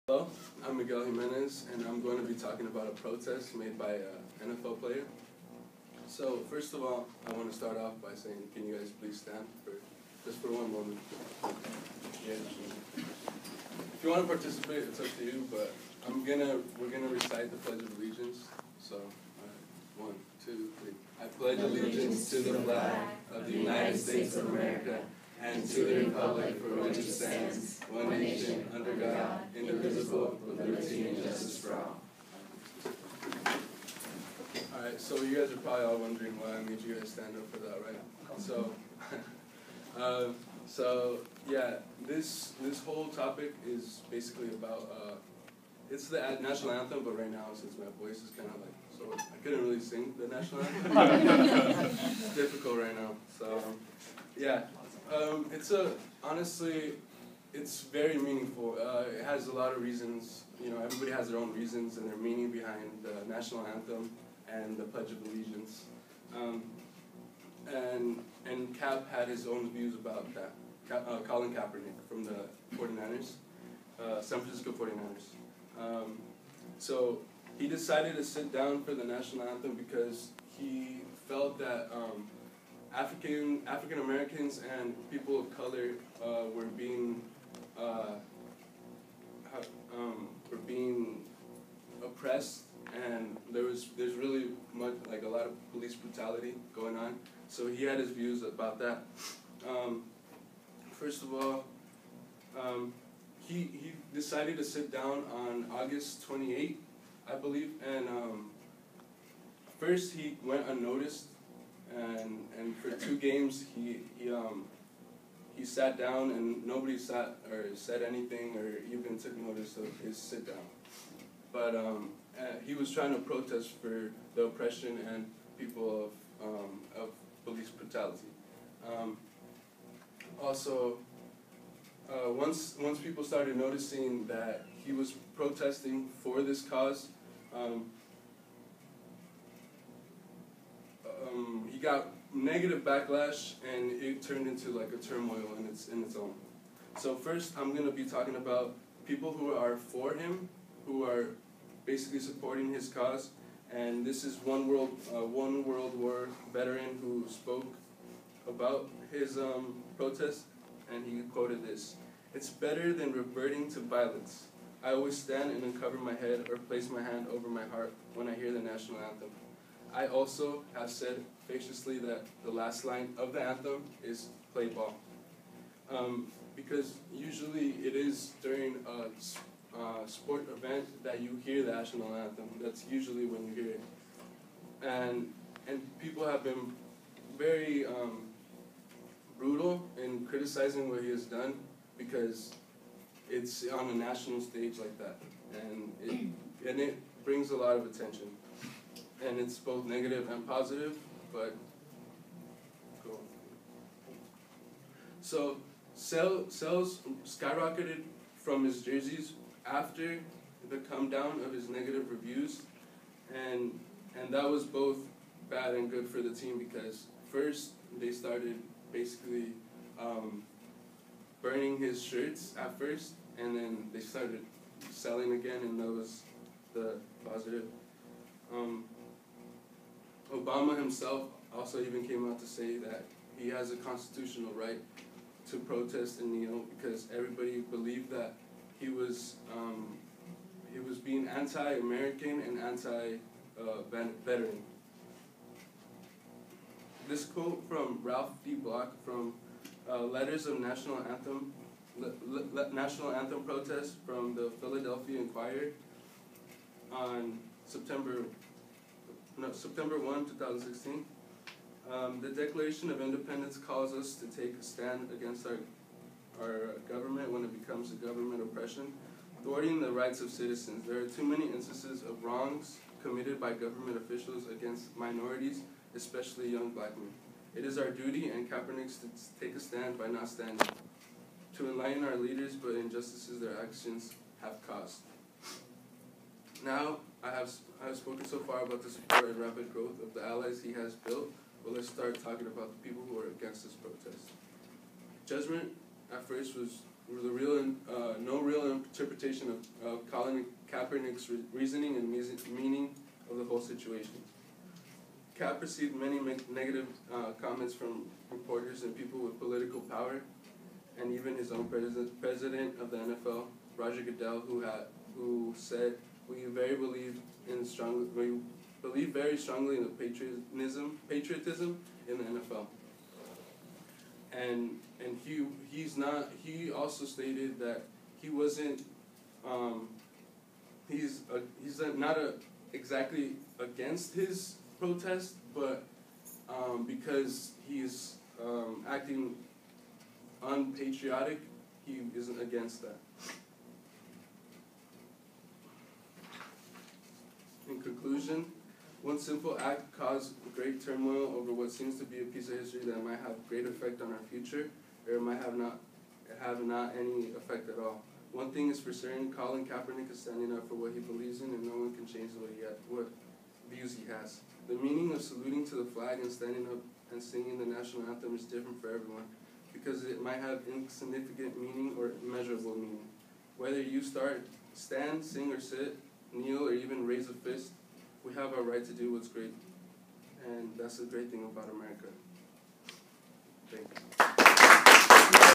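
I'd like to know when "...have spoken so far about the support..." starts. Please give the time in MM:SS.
04:47.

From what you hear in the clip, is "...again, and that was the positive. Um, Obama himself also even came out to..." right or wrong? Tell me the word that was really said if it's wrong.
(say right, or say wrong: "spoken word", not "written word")
right.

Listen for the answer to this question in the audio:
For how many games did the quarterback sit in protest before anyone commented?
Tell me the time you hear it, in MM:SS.
01:52.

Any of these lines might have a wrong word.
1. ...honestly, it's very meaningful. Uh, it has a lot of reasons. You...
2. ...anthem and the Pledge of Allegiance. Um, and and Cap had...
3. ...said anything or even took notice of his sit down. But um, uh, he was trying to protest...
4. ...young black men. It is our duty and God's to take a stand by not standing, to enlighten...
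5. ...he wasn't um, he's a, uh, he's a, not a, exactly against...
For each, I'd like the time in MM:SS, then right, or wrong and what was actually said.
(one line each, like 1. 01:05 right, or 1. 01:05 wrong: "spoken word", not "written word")
1. 00:56 right
2. 01:03 right
3. 01:57 right
4. 04:36 wrong: "Kaepernick", not "God"
5. 05:28 right.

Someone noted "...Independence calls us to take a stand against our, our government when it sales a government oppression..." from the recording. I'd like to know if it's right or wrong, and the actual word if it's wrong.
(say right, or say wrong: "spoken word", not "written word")
wrong: "becomes", not "sales".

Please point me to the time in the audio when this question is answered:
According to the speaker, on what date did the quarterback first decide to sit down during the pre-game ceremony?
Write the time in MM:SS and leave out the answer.
01:45.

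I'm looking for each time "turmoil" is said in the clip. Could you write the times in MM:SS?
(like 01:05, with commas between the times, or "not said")
02:24, 05:50.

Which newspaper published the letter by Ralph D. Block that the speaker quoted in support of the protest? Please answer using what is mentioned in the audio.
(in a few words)
Philadelphia Inquirer.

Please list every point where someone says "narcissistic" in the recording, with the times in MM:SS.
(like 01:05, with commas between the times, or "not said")
not said.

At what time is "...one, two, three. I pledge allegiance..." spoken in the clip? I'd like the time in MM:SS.
00:20.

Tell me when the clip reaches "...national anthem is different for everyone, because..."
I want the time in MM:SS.
06:07.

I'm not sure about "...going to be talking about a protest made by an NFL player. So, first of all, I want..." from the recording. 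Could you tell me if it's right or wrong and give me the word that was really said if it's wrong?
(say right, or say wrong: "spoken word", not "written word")
right.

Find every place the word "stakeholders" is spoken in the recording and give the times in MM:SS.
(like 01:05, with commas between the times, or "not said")
not said.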